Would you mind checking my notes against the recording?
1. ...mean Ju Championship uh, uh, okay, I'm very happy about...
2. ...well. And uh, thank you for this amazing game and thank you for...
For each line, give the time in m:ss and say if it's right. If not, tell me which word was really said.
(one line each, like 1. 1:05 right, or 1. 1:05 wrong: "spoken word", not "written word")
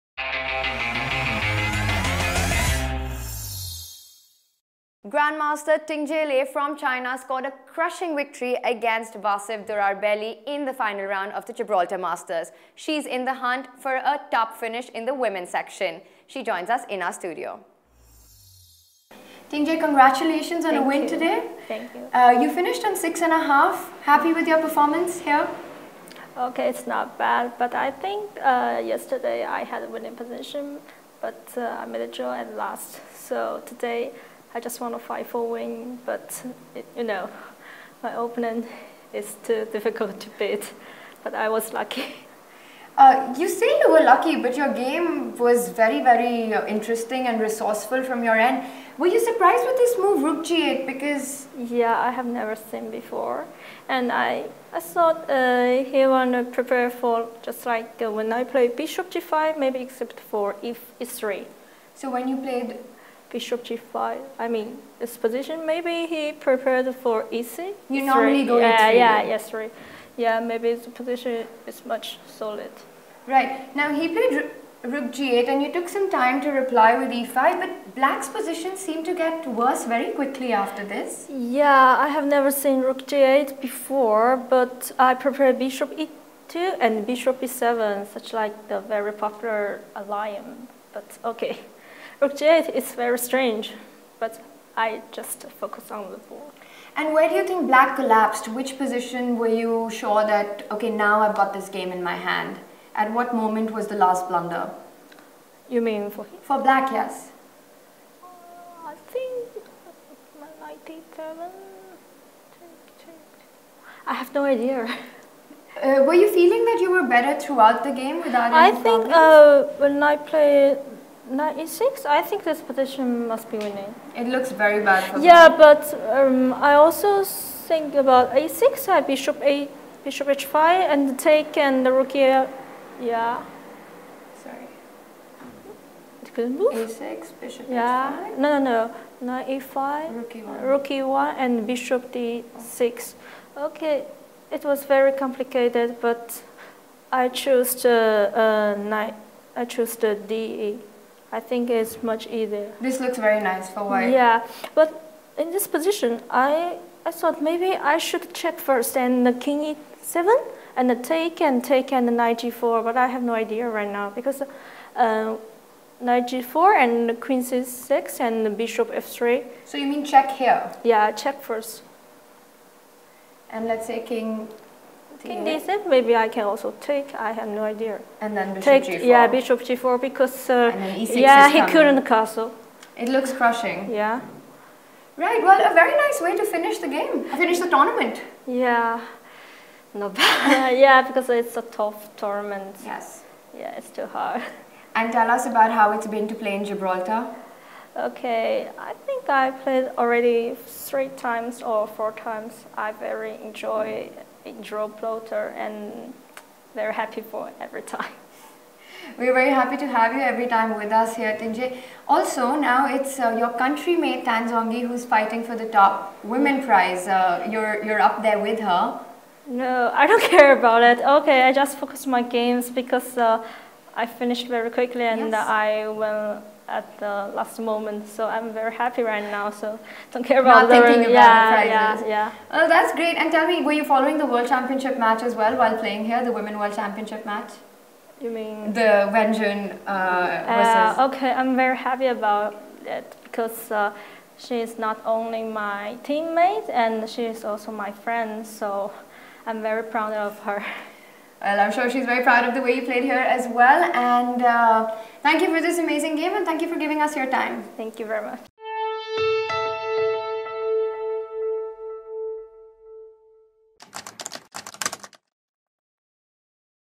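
1. 3:58 wrong: "Wenjun", not "Championship"
2. 4:13 right.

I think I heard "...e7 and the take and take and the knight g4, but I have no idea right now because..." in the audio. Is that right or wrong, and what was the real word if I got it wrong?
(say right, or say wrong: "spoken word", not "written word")
right.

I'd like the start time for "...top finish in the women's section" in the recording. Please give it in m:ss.
0:14.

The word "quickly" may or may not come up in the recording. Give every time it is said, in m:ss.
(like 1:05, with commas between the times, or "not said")
1:20, 3:44.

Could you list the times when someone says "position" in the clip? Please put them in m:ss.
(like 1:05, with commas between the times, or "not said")
0:30, 1:05, 1:10, 1:18, 1:38, 2:35.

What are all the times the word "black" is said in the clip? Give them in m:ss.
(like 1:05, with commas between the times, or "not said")
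1:17, 1:37, 1:46.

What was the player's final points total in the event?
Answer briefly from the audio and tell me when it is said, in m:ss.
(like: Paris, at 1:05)
6.5, at 0:22.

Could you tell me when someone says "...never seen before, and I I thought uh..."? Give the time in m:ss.
0:52.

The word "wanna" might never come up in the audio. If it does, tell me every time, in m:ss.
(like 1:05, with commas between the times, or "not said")
0:56.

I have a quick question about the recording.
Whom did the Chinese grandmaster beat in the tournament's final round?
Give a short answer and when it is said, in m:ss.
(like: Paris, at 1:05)
Vasif Durarbayli, at 0:09.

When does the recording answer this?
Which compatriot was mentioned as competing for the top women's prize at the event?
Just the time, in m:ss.
3:34.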